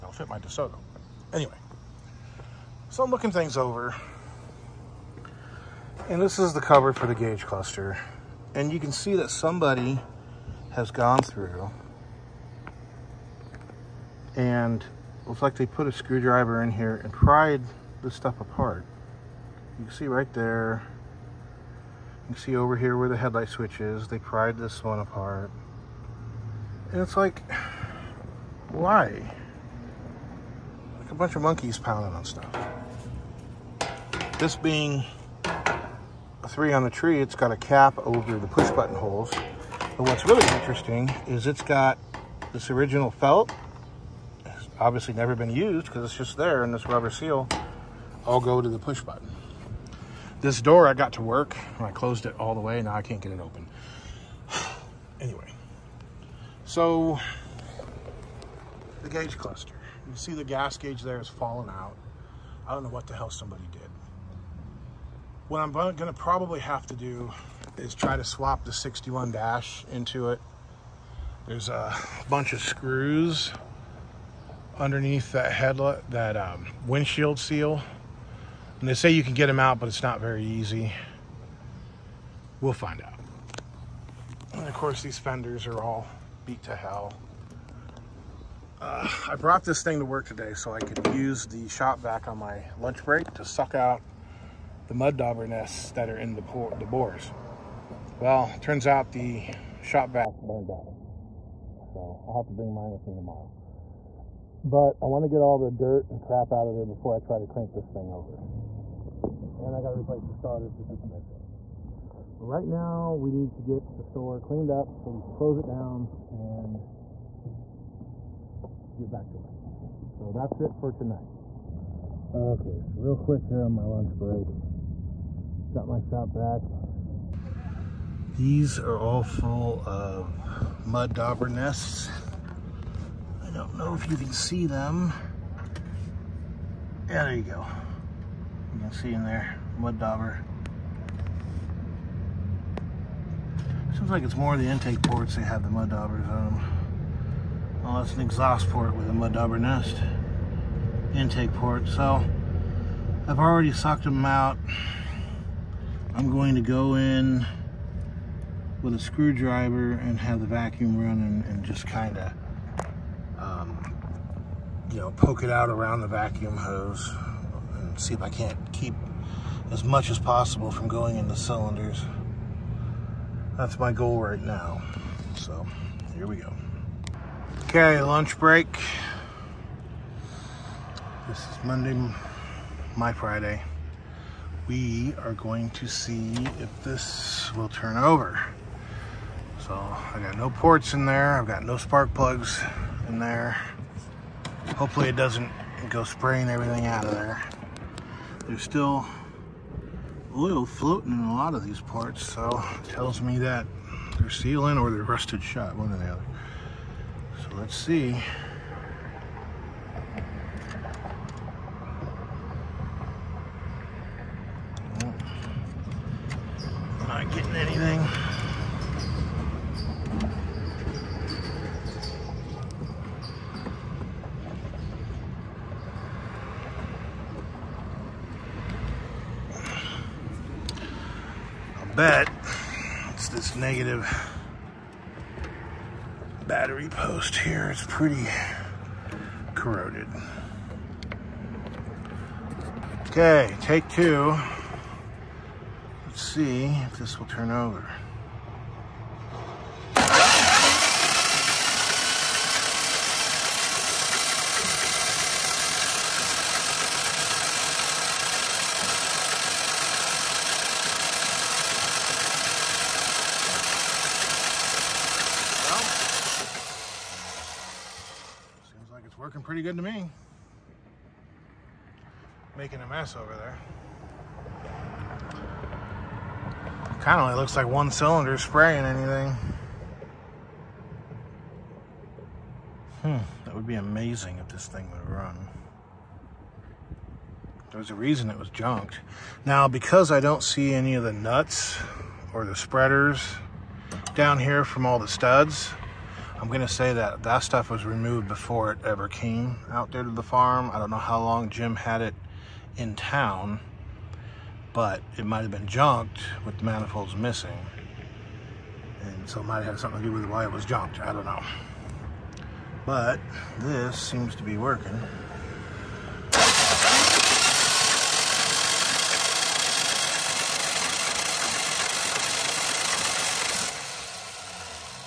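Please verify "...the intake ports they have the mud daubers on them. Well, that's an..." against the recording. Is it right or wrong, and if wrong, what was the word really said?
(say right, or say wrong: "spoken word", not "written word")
right.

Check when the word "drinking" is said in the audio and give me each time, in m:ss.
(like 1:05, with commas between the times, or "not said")
not said.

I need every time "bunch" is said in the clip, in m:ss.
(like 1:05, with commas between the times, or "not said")
0:31, 1:12.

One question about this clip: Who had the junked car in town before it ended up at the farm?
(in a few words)
Jim.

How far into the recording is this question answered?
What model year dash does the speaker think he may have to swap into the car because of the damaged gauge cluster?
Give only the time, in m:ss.
1:08.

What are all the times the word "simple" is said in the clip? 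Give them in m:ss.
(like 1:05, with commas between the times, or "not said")
not said.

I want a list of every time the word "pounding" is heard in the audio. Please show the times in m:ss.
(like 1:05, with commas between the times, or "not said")
0:31.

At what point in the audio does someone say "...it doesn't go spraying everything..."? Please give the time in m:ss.
3:15.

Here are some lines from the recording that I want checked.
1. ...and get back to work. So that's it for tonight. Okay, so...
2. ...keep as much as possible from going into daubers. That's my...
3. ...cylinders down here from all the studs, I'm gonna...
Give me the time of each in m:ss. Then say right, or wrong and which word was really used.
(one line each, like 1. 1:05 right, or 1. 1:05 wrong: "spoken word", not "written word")
1. 1:56 right
2. 2:48 wrong: "cylinders", not "daubers"
3. 4:52 wrong: "spreaders", not "cylinders".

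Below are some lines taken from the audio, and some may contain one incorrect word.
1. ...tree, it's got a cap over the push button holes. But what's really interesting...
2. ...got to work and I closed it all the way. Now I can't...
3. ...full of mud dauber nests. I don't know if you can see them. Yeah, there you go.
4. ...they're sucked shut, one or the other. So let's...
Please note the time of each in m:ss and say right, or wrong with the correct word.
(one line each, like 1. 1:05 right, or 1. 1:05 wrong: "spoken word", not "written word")
1. 0:36 right
2. 0:50 right
3. 2:09 right
4. 3:24 wrong: "rusted", not "sucked".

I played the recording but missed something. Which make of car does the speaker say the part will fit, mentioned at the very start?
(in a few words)
DeSoto.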